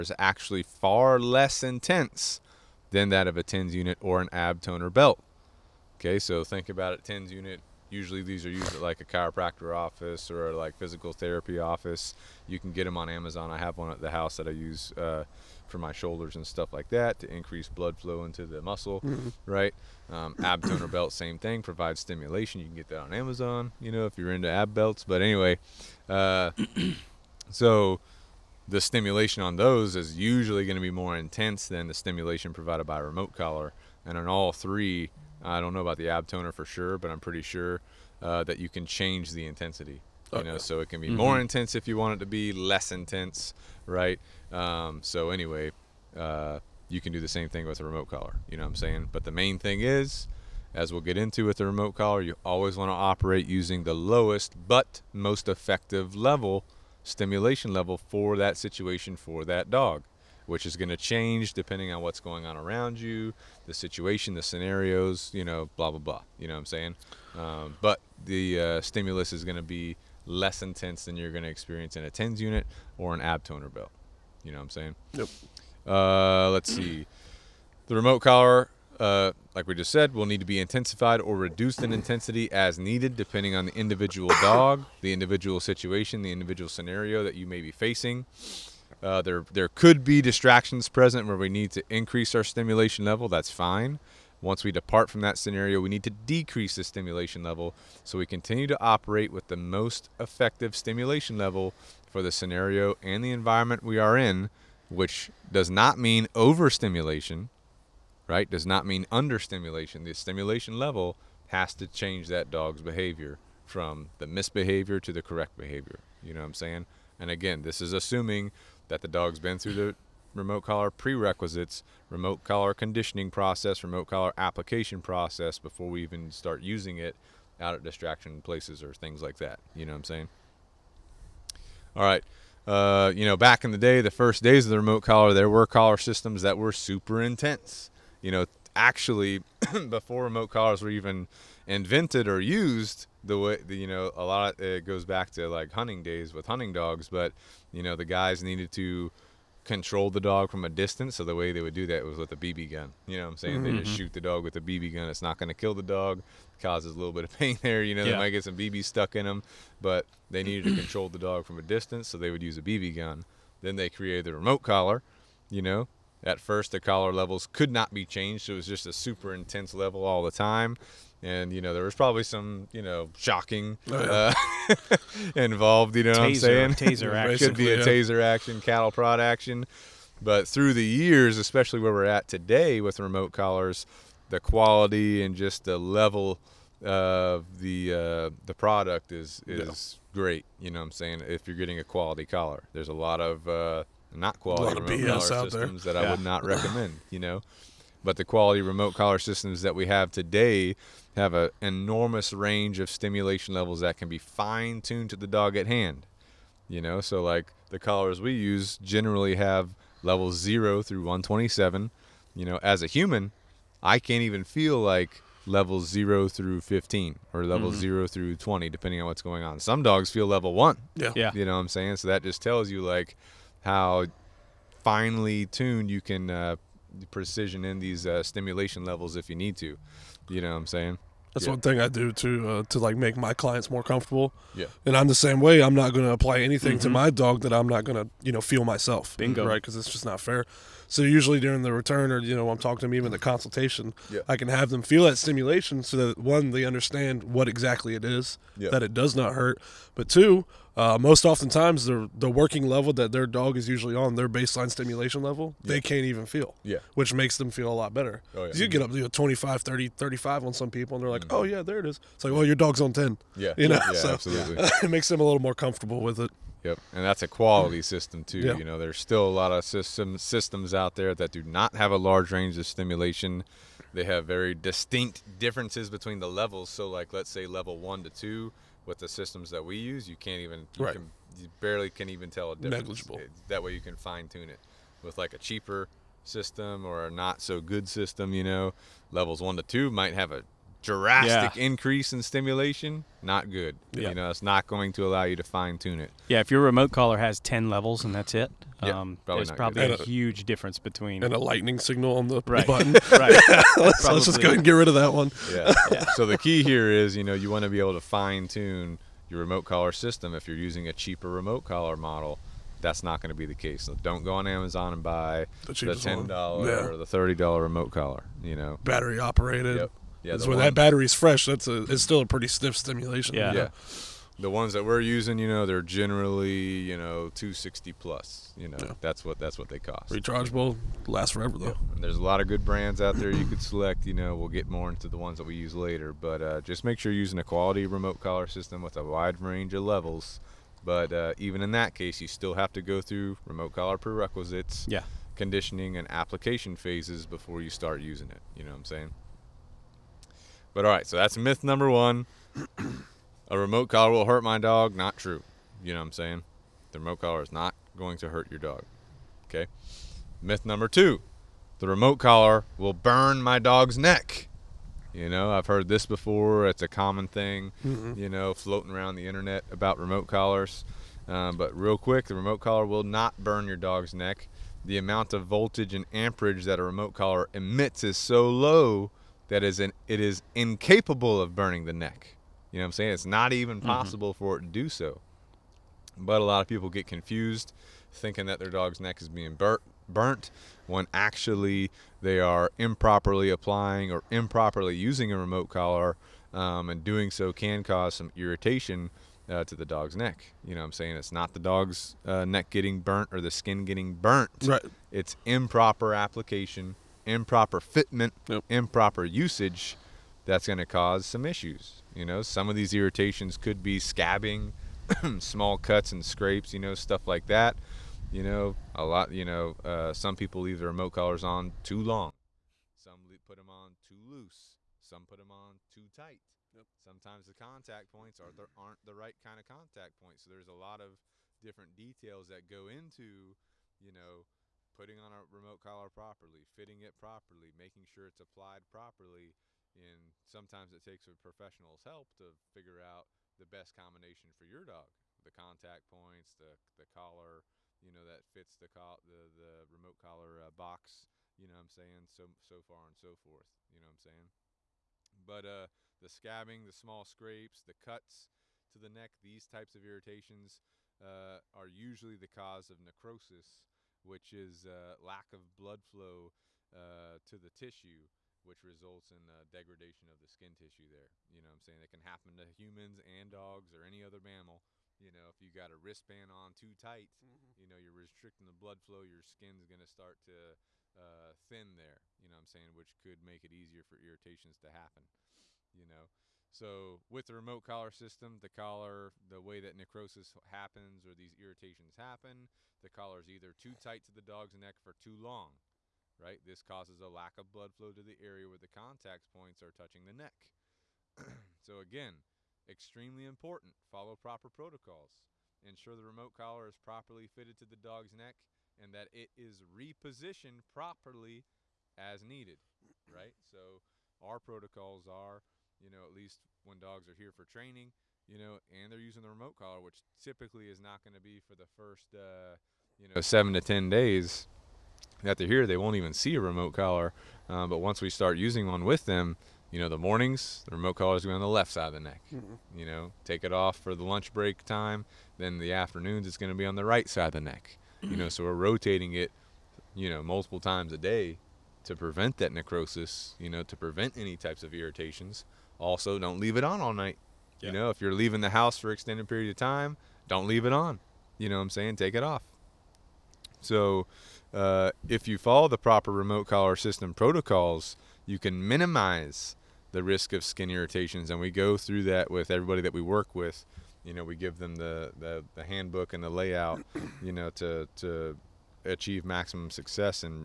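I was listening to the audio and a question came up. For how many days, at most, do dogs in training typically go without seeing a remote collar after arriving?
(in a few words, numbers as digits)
10 days.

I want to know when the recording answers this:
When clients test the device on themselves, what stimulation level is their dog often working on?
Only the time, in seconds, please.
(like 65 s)
262 s.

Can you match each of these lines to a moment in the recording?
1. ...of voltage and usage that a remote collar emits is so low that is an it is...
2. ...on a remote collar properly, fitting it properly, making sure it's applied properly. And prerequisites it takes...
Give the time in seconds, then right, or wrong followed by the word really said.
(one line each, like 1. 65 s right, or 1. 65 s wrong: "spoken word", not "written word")
1. 375 s wrong: "amperage", not "usage"
2. 435 s wrong: "sometimes", not "prerequisites".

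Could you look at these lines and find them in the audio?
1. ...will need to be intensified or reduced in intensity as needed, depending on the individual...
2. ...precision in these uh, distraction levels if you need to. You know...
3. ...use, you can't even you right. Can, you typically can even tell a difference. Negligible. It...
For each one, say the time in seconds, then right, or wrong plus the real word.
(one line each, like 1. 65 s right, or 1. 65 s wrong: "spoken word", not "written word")
1. 80 s right
2. 227 s wrong: "stimulation", not "distraction"
3. 279 s wrong: "barely", not "typically".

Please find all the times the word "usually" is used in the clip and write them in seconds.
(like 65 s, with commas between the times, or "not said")
7 s, 30 s, 241 s, 253 s, 461 s.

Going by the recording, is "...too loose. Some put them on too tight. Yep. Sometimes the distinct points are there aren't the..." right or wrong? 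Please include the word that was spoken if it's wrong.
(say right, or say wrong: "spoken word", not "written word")
wrong: "contact", not "distinct".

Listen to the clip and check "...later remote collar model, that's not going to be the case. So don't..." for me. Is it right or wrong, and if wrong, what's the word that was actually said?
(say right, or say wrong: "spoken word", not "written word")
wrong: "cheaper", not "later".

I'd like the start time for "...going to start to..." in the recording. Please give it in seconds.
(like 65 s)
479 s.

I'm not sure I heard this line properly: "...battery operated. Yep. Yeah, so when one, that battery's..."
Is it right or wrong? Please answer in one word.
right.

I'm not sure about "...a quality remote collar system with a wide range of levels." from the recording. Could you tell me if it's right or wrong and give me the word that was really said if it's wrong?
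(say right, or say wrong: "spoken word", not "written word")
right.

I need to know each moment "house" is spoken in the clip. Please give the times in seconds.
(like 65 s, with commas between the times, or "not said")
14 s, 548 s.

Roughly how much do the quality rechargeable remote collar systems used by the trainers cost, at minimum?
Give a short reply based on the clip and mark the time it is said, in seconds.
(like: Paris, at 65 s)
260, at 327 s.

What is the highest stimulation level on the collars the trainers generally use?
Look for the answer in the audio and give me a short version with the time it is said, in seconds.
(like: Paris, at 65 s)
127, at 211 s.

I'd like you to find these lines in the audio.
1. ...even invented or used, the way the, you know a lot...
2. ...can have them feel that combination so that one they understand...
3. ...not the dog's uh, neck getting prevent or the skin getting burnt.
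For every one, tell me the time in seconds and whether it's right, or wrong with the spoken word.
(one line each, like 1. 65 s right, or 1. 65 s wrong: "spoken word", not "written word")
1. 140 s right
2. 244 s wrong: "stimulation", not "combination"
3. 401 s wrong: "burnt", not "prevent".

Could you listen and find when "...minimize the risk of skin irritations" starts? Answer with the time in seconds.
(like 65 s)
558 s.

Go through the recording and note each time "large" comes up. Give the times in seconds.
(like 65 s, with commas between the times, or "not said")
271 s.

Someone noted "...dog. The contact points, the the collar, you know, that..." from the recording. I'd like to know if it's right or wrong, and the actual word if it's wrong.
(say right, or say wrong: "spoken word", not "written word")
right.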